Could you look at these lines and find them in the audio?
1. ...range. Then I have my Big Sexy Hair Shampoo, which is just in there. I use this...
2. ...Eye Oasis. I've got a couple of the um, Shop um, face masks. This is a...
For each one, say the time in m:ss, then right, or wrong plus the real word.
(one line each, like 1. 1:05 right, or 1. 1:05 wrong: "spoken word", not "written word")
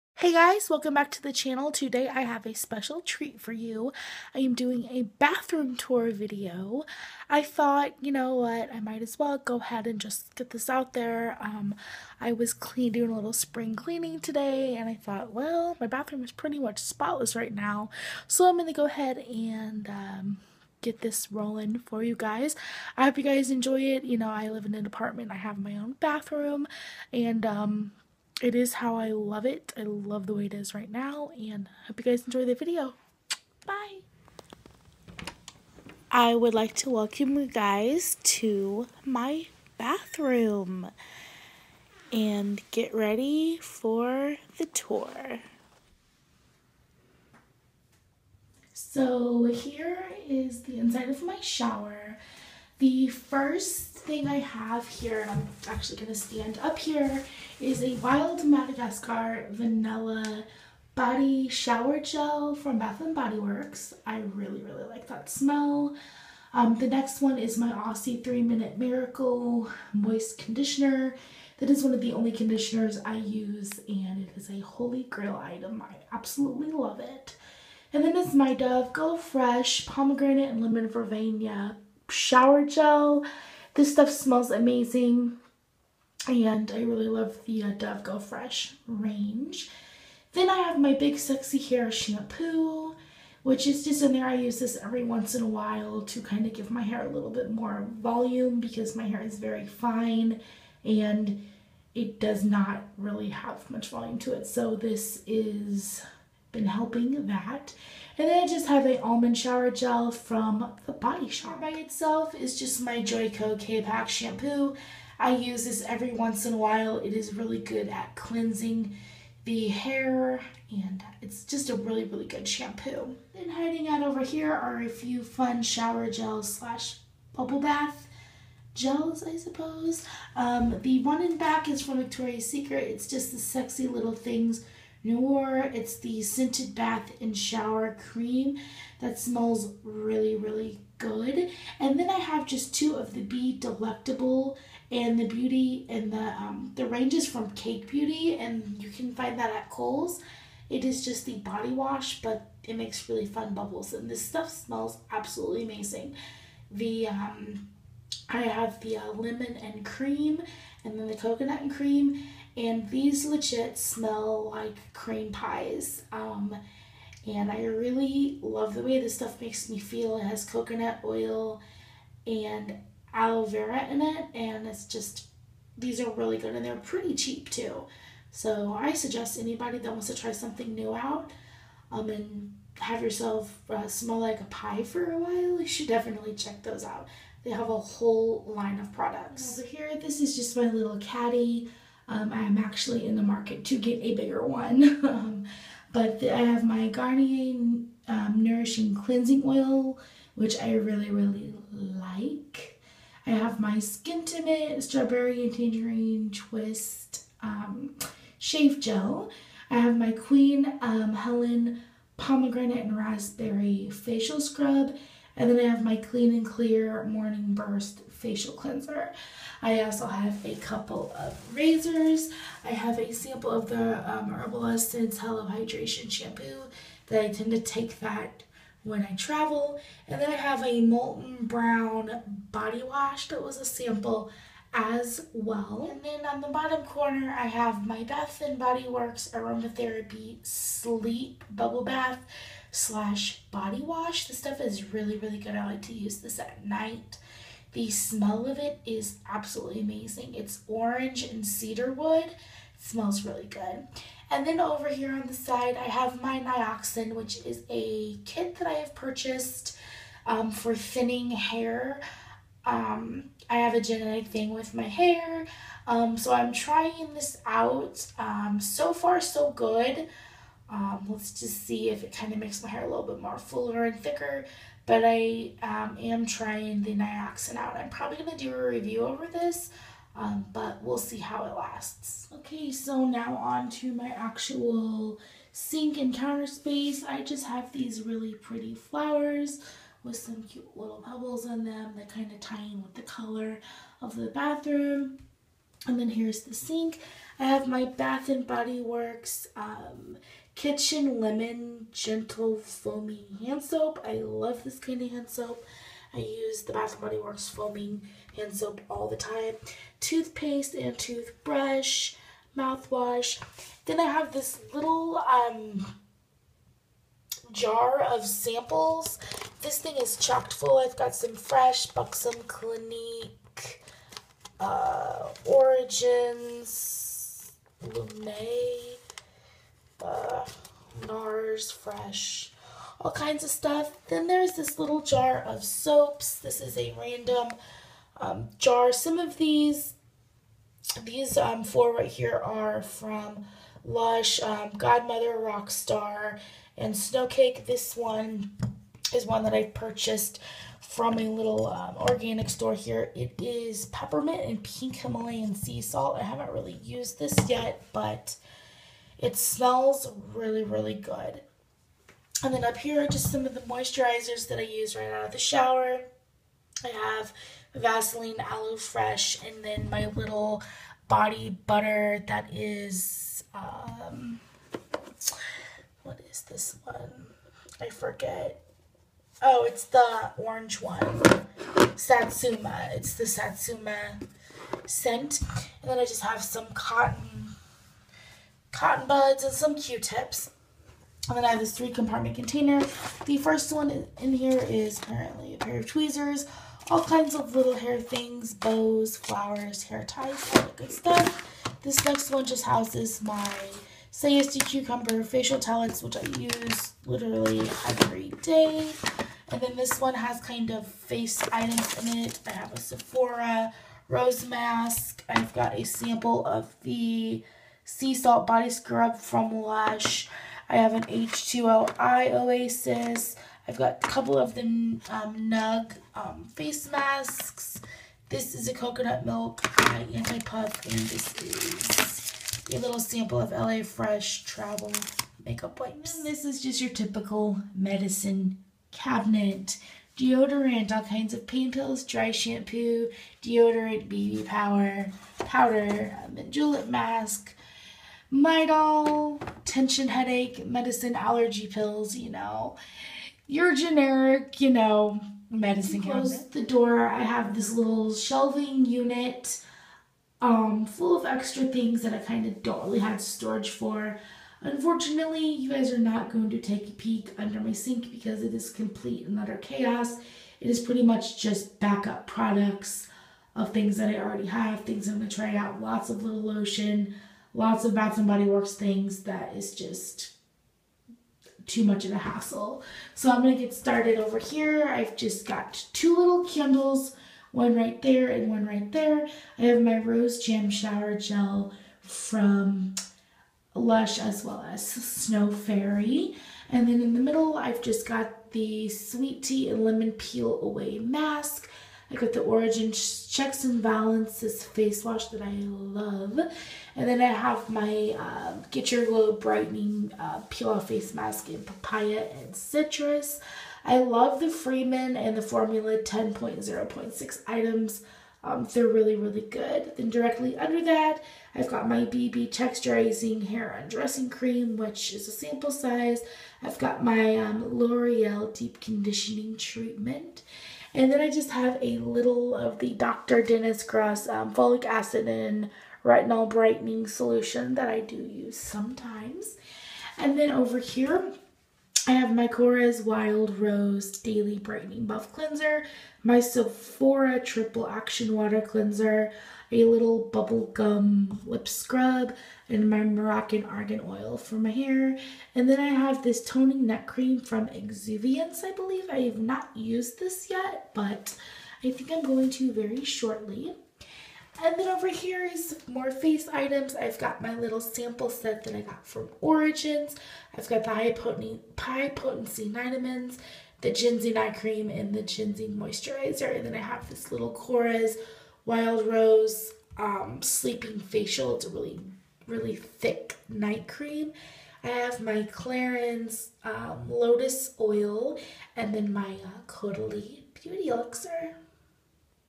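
1. 1:28 right
2. 7:01 wrong: "Nug", not "Shop".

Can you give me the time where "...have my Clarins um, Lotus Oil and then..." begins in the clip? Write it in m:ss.
9:44.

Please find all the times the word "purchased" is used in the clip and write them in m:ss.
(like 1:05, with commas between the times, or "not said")
4:18, 5:49.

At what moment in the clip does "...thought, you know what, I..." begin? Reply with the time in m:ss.
0:07.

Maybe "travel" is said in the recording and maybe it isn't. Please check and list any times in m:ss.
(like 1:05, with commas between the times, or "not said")
3:49, 7:14.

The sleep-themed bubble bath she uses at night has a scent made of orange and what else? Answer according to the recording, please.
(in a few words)
cedar wood.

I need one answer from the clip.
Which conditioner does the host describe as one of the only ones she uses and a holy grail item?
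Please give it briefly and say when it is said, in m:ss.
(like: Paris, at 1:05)
Aussie 3 Minute Miracle Moist, at 1:07.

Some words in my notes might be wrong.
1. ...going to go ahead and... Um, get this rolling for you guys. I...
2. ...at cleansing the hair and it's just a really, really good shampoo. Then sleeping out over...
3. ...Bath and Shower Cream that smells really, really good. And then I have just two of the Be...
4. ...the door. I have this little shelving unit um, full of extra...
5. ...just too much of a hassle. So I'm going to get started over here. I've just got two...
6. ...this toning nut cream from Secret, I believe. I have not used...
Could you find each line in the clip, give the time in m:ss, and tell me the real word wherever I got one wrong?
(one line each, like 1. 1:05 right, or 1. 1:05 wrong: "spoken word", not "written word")
1. 0:18 right
2. 1:57 wrong: "hiding", not "sleeping"
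3. 2:16 right
4. 7:36 right
5. 7:59 right
6. 9:16 wrong: "Exuviance", not "Secret".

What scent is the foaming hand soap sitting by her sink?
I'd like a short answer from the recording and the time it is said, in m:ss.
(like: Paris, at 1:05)
Kitchen Lemon, at 5:00.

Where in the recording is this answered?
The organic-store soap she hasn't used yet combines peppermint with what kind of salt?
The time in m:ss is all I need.
5:54.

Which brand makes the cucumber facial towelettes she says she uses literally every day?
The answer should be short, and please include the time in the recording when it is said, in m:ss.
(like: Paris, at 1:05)
Sayesti, at 6:44.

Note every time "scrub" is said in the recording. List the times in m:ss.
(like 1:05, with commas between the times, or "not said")
3:34, 6:58, 9:11.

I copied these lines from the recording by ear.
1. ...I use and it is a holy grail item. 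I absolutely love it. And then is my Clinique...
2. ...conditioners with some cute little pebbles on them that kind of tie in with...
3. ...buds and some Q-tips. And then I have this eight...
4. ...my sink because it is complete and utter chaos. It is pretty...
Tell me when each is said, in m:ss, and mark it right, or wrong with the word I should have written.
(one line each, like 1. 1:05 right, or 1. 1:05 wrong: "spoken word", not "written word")
1. 1:13 wrong: "Dove", not "Clinique"
2. 4:48 wrong: "flowers", not "conditioners"
3. 6:29 wrong: "three", not "eight"
4. 7:47 right.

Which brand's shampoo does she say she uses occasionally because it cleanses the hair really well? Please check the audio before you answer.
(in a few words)
Joico K-Pak.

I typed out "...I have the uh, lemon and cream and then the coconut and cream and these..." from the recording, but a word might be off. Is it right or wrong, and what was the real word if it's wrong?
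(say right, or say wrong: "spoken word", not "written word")
right.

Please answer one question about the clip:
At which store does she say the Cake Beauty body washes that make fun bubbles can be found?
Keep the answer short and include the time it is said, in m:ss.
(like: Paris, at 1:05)
Kohl's, at 2:29.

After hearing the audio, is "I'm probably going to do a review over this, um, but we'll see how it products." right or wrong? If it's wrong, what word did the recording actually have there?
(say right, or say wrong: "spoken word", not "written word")
wrong: "lasts", not "products".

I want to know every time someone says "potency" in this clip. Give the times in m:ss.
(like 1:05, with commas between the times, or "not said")
9:32.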